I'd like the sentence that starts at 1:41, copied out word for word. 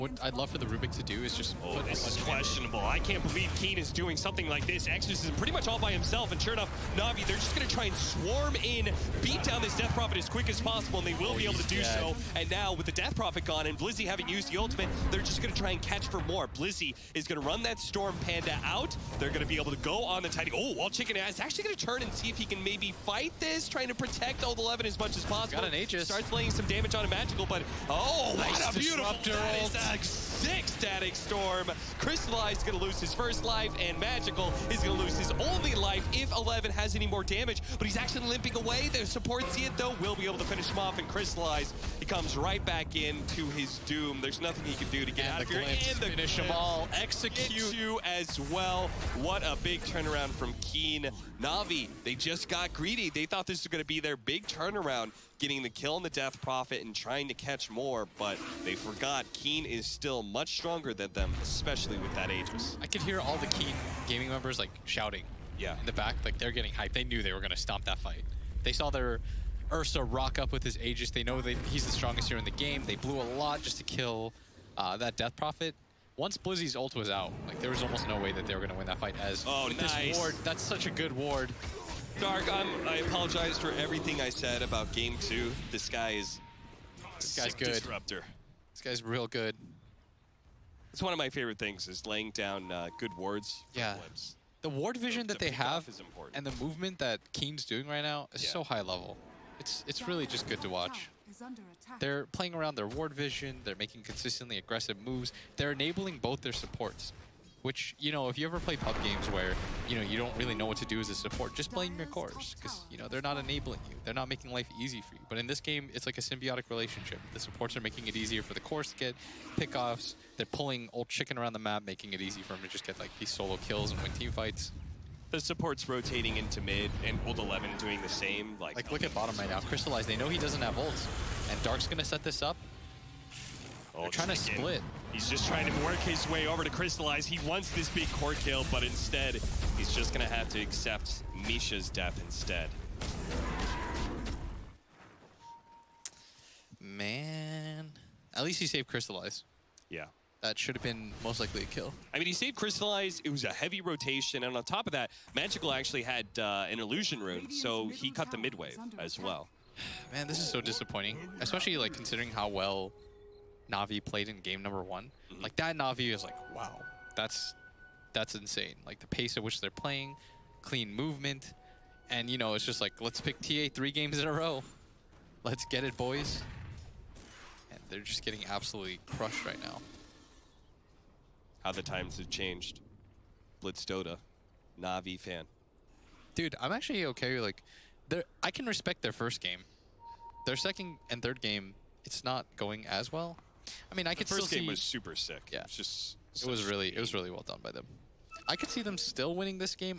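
They're playing around their ward vision.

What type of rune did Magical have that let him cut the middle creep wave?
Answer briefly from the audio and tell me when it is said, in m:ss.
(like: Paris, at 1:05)
Illusion Rune, at 2:36.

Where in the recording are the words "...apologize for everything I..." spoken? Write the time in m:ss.
1:22.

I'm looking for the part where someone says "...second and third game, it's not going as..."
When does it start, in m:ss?
3:10.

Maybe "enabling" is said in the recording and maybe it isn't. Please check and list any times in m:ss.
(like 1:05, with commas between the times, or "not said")
1:45, 1:53.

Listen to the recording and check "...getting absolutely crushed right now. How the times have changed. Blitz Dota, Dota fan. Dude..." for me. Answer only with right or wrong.
wrong.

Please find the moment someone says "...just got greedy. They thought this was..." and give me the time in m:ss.
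0:52.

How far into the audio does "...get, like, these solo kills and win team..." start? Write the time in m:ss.
2:02.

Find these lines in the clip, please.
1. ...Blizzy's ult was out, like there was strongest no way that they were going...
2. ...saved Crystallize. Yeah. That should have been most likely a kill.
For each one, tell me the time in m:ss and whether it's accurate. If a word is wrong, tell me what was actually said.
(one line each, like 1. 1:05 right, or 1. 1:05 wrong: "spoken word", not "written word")
1. 1:16 wrong: "almost", not "strongest"
2. 2:28 right.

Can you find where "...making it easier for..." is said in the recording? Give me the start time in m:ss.
1:57.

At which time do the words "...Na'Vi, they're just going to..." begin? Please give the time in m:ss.
0:06.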